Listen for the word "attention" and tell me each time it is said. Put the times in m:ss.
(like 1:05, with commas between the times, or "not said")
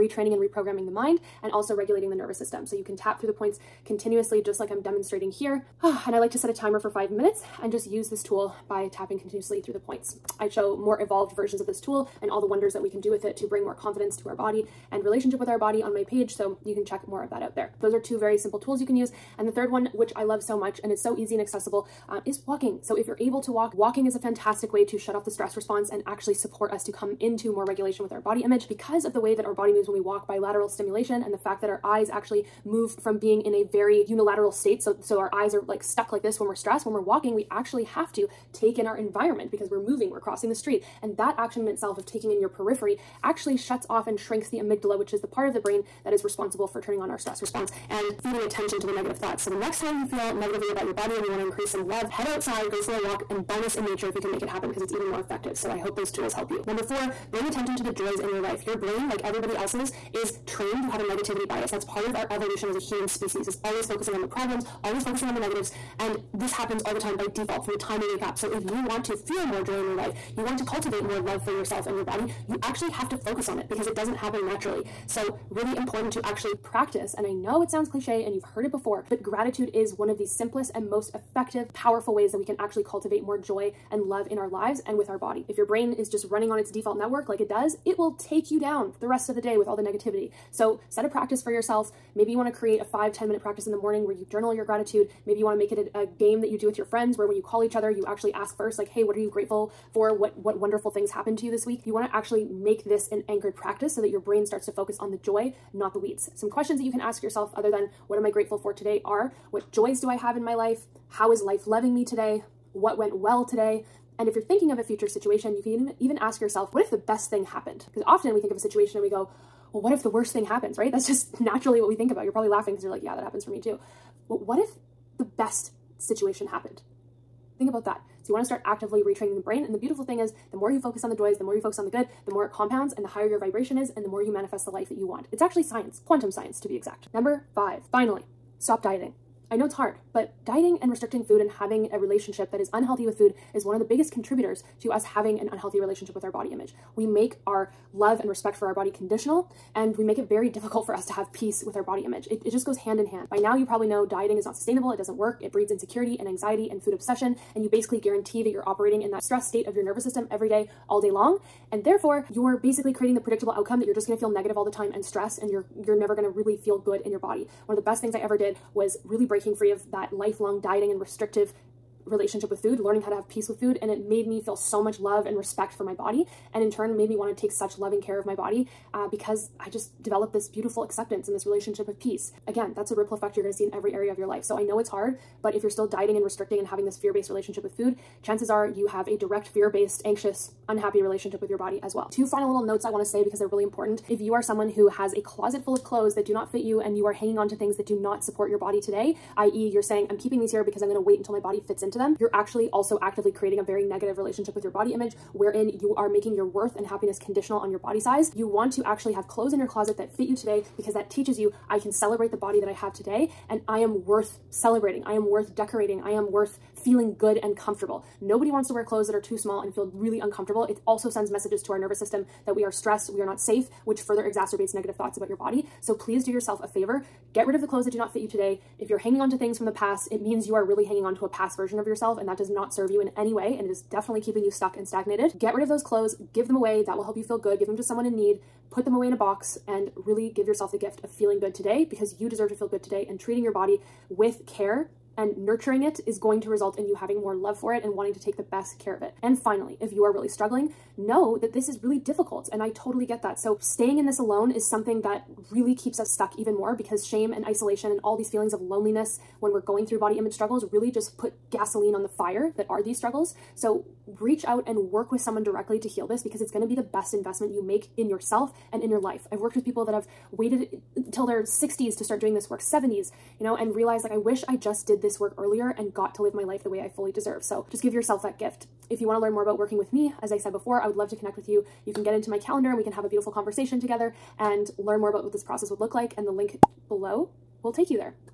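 0:48, 0:57.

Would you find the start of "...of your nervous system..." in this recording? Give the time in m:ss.
2:39.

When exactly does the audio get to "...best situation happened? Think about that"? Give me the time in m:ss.
2:05.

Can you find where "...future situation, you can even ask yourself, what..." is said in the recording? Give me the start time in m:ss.
1:54.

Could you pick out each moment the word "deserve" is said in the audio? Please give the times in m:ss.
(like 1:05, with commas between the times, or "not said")
4:02, 4:37.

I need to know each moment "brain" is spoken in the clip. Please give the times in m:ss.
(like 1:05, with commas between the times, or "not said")
0:45, 0:58, 1:25, 1:44, 2:09.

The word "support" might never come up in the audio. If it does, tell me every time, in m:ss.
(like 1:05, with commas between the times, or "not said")
0:26, 3:18.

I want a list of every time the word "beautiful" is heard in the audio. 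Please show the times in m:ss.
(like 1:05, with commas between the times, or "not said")
2:09, 3:00, 4:43.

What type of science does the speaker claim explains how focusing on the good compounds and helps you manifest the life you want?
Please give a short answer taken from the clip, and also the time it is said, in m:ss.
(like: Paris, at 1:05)
Quantum science, at 2:16.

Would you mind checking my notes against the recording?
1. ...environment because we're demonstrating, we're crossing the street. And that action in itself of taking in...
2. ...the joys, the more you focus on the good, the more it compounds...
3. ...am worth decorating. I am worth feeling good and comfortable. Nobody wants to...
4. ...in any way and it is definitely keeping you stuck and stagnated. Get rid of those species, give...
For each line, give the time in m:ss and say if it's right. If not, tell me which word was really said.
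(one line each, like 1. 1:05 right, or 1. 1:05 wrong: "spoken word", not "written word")
1. 0:38 wrong: "moving", not "demonstrating"
2. 2:11 right
3. 3:35 right
4. 3:53 wrong: "clothes", not "species".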